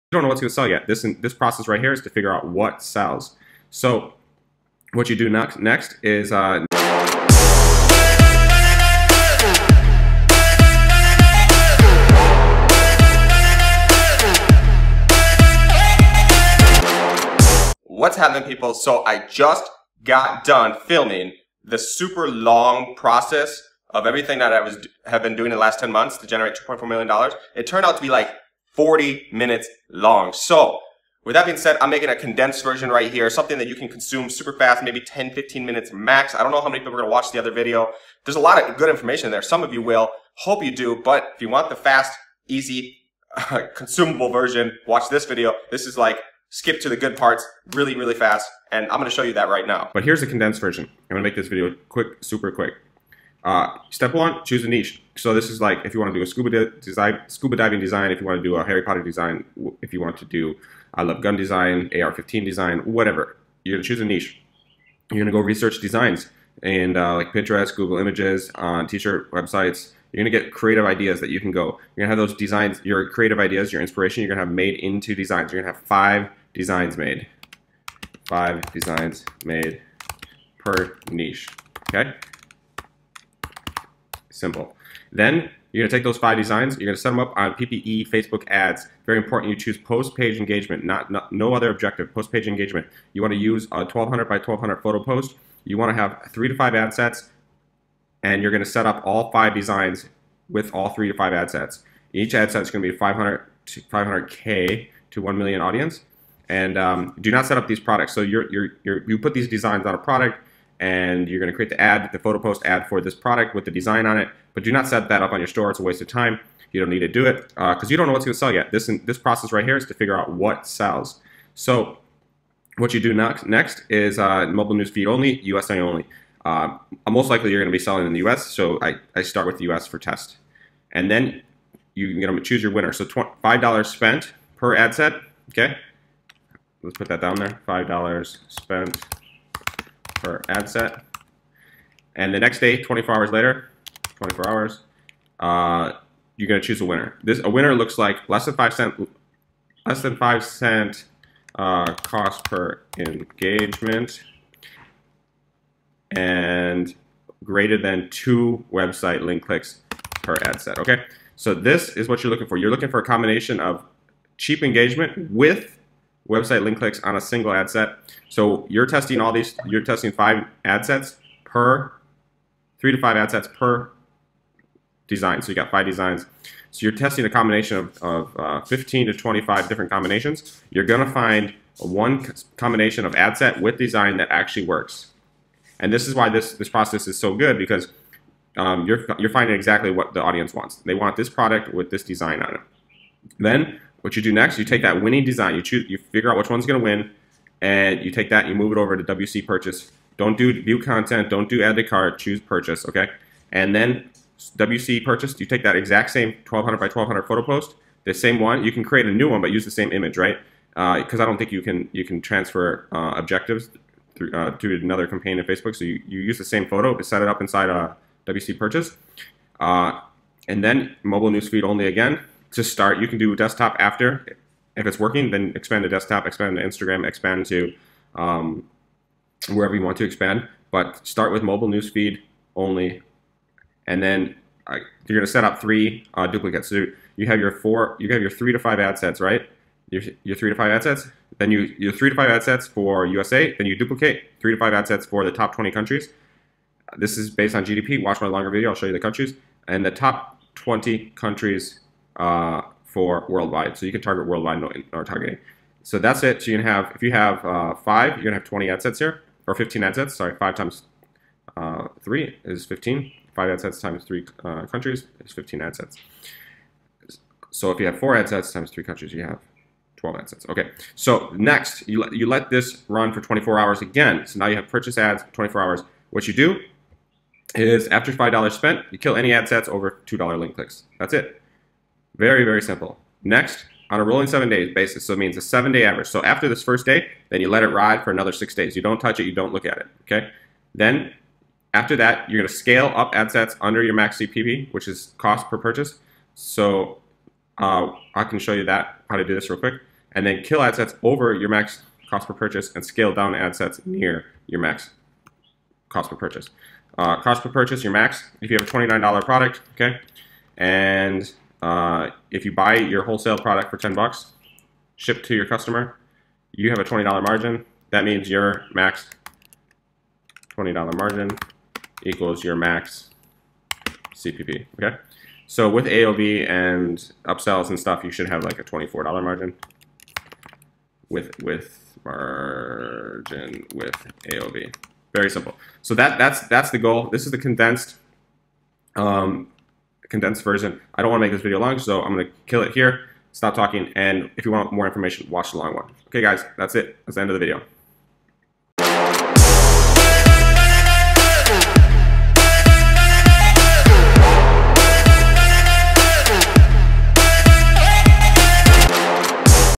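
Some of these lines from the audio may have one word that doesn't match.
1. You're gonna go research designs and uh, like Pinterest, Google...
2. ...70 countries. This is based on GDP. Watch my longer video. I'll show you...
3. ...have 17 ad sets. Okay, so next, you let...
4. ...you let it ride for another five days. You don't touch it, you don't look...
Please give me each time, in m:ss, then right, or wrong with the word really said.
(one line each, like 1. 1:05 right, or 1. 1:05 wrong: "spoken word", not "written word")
1. 1:05 right
2. 4:05 wrong: "20", not "70"
3. 4:29 wrong: "12", not "17"
4. 4:47 wrong: "six", not "five".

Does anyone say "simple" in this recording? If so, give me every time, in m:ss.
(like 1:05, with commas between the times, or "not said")
1:24, 4:42, 5:35.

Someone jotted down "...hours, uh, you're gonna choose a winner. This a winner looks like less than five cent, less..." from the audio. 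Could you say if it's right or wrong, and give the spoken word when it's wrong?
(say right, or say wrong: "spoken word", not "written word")
right.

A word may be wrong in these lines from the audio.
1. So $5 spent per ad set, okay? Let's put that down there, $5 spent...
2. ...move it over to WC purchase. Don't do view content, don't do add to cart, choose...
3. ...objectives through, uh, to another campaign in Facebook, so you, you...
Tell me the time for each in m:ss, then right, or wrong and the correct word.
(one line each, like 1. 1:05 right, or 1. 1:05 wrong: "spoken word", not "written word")
1. 2:12 right
2. 3:18 right
3. 3:33 right.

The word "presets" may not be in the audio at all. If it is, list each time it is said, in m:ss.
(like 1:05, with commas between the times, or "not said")
not said.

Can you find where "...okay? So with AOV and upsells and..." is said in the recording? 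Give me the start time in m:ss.
5:24.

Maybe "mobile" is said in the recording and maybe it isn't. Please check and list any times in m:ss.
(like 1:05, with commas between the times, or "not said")
2:04, 3:41, 3:51.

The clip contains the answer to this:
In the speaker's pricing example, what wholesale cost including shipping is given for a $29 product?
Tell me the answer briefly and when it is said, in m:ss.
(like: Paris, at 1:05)
$10, at 5:13.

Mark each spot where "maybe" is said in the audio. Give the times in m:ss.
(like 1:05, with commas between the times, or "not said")
0:34.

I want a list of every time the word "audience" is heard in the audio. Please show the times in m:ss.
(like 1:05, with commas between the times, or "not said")
1:45, 3:10.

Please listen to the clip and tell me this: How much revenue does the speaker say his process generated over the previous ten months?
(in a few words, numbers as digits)
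$2.4 million.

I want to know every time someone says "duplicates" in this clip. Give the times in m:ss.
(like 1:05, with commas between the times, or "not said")
3:56, 4:03.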